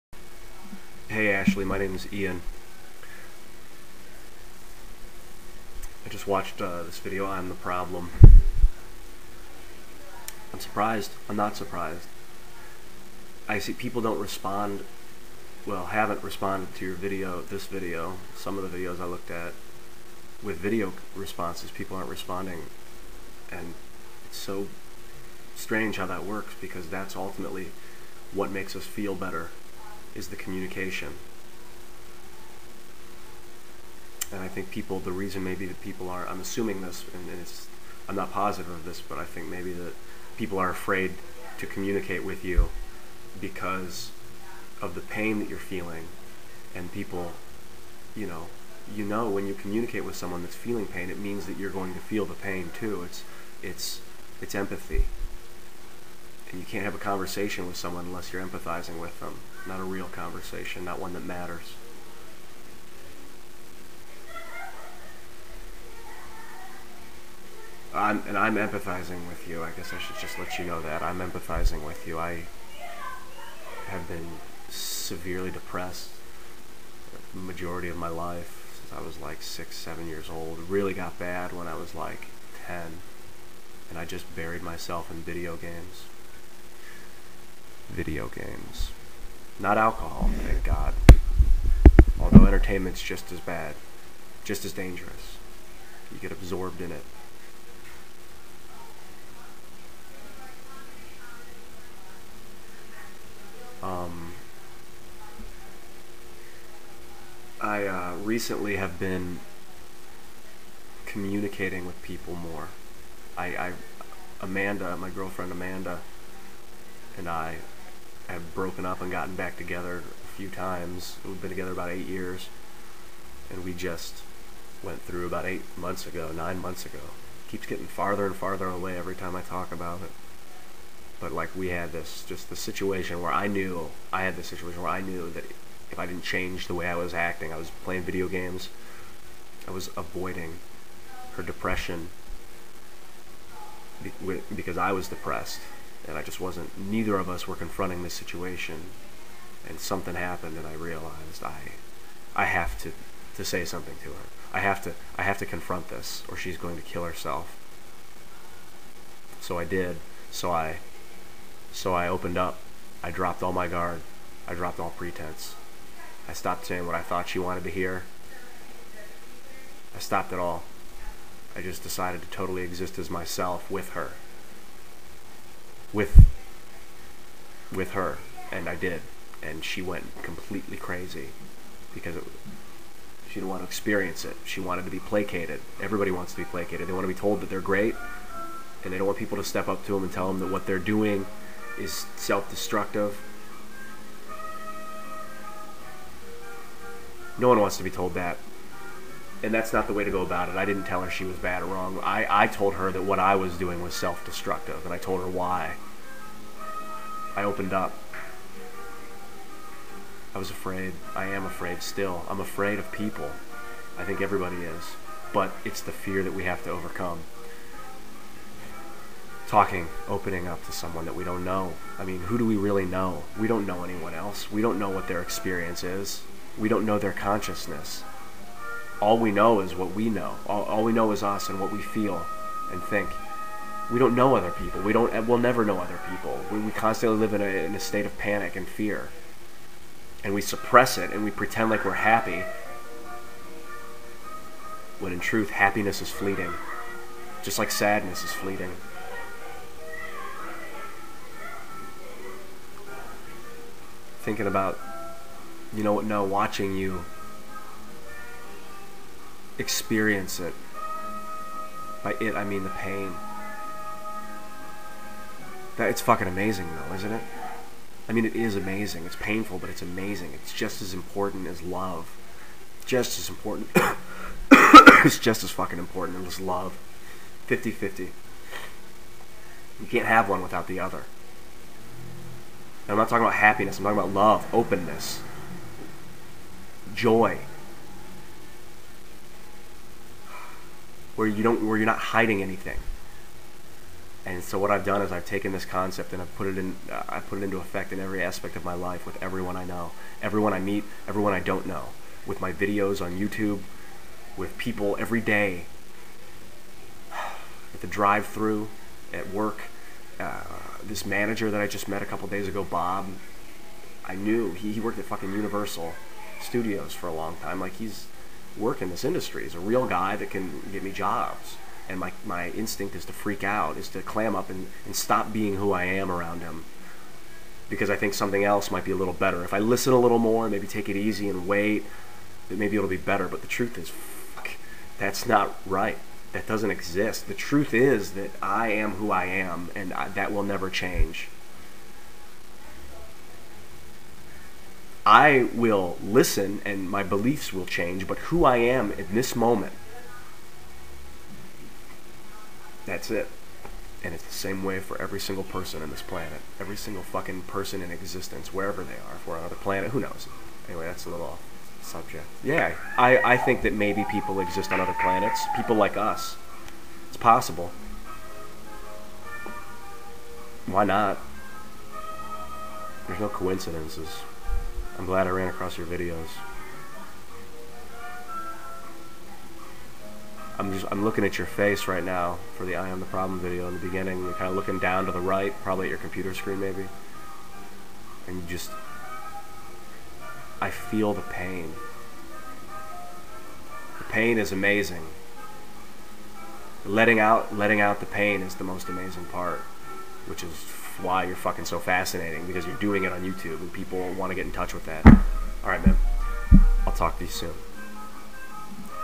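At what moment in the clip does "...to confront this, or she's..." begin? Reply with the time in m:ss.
2:35.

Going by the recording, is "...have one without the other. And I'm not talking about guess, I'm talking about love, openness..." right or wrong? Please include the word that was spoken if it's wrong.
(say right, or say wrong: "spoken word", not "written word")
wrong: "happiness", not "guess".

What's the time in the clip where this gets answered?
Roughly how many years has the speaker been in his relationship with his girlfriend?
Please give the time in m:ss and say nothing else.
2:01.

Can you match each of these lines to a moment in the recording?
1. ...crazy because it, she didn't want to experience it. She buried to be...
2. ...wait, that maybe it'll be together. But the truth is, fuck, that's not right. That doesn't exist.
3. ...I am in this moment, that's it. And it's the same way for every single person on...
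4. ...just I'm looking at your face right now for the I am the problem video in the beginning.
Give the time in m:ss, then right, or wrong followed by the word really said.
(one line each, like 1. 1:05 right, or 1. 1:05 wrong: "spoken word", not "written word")
1. 3:00 wrong: "wanted", not "buried"
2. 5:31 wrong: "better", not "together"
3. 5:48 right
4. 6:20 right.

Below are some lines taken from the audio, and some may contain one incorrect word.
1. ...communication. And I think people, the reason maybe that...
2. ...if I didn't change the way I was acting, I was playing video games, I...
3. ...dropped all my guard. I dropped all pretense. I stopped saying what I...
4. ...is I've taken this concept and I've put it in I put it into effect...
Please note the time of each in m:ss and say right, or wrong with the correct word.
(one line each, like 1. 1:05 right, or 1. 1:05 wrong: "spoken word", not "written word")
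1. 0:30 right
2. 2:15 right
3. 2:43 right
4. 4:55 right.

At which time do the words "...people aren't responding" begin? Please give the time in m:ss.
0:21.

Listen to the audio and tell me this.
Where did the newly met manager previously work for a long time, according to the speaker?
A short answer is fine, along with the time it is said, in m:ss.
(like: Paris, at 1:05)
Universal Studios, at 5:15.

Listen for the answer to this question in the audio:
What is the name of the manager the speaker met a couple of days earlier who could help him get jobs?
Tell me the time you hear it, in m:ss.
5:12.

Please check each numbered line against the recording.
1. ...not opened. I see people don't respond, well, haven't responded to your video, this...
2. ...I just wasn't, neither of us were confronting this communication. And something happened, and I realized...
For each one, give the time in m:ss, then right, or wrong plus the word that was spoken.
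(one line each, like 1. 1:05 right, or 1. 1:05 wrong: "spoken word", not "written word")
1. 0:11 wrong: "surprised", not "opened"
2. 2:26 wrong: "situation", not "communication".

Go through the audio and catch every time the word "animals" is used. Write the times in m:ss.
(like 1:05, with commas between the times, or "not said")
not said.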